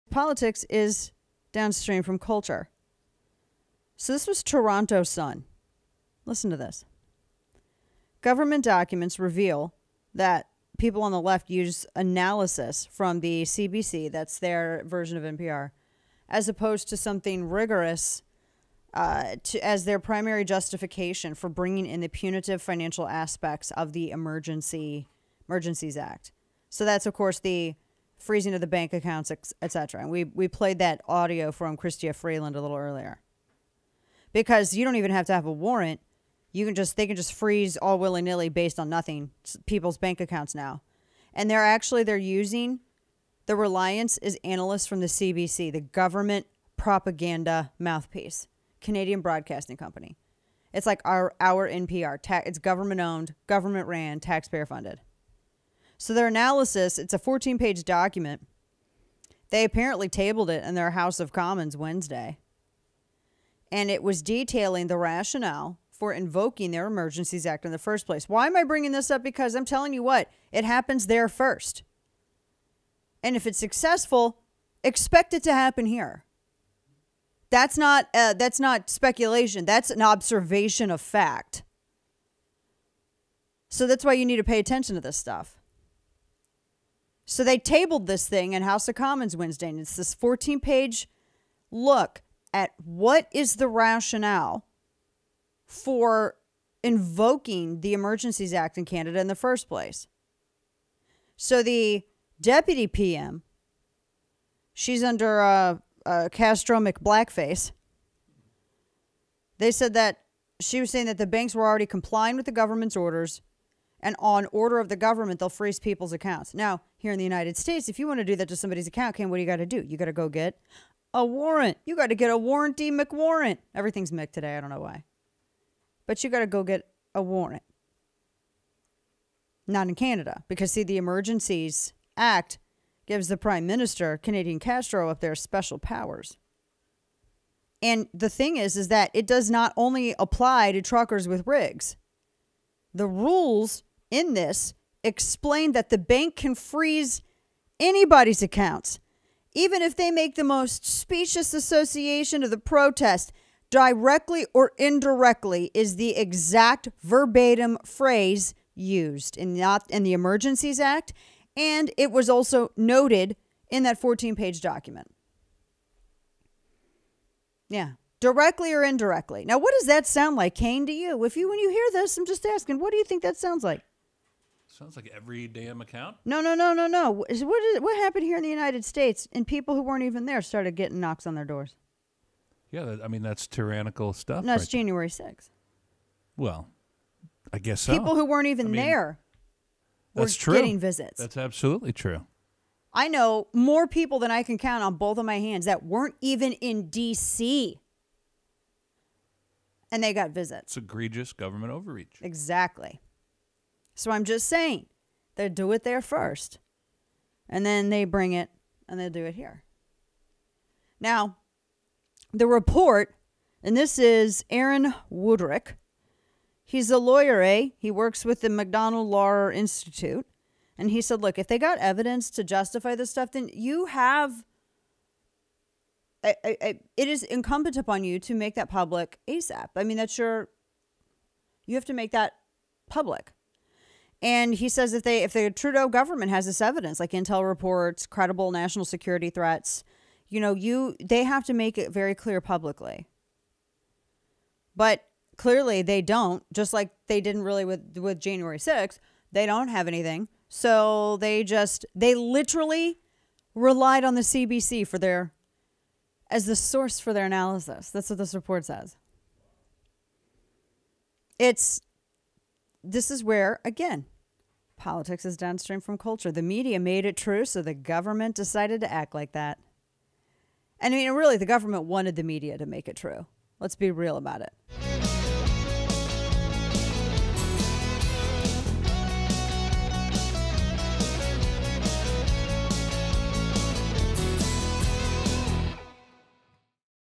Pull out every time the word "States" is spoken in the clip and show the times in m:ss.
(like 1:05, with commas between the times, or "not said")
1:57, 2:58.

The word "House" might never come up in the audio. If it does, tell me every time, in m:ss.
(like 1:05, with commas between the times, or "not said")
1:00, 1:28.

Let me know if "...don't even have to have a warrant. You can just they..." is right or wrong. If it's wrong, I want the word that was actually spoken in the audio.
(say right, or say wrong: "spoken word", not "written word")
right.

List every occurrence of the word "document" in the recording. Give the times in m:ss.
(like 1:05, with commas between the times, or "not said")
0:08, 0:57, 2:44.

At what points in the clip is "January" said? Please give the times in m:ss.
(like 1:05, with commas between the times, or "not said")
3:04, 4:08.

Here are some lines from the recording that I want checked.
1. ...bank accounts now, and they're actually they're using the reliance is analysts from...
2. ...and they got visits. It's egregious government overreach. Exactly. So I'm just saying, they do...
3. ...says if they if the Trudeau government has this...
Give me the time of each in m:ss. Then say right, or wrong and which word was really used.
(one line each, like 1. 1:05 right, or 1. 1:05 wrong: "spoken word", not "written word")
1. 0:39 right
2. 3:19 right
3. 3:54 right.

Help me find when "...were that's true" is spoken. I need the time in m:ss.
3:10.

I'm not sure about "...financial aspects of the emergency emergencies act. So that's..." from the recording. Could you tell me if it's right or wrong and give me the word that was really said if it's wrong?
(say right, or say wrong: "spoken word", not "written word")
right.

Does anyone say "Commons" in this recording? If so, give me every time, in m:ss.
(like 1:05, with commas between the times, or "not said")
1:01, 1:28.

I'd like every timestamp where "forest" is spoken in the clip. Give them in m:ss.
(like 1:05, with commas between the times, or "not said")
not said.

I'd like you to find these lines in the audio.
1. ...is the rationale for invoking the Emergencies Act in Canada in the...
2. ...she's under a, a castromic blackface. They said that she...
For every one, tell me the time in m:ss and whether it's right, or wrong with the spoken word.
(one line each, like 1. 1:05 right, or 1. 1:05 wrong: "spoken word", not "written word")
1. 1:33 right
2. 1:44 right.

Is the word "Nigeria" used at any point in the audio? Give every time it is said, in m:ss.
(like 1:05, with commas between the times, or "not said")
not said.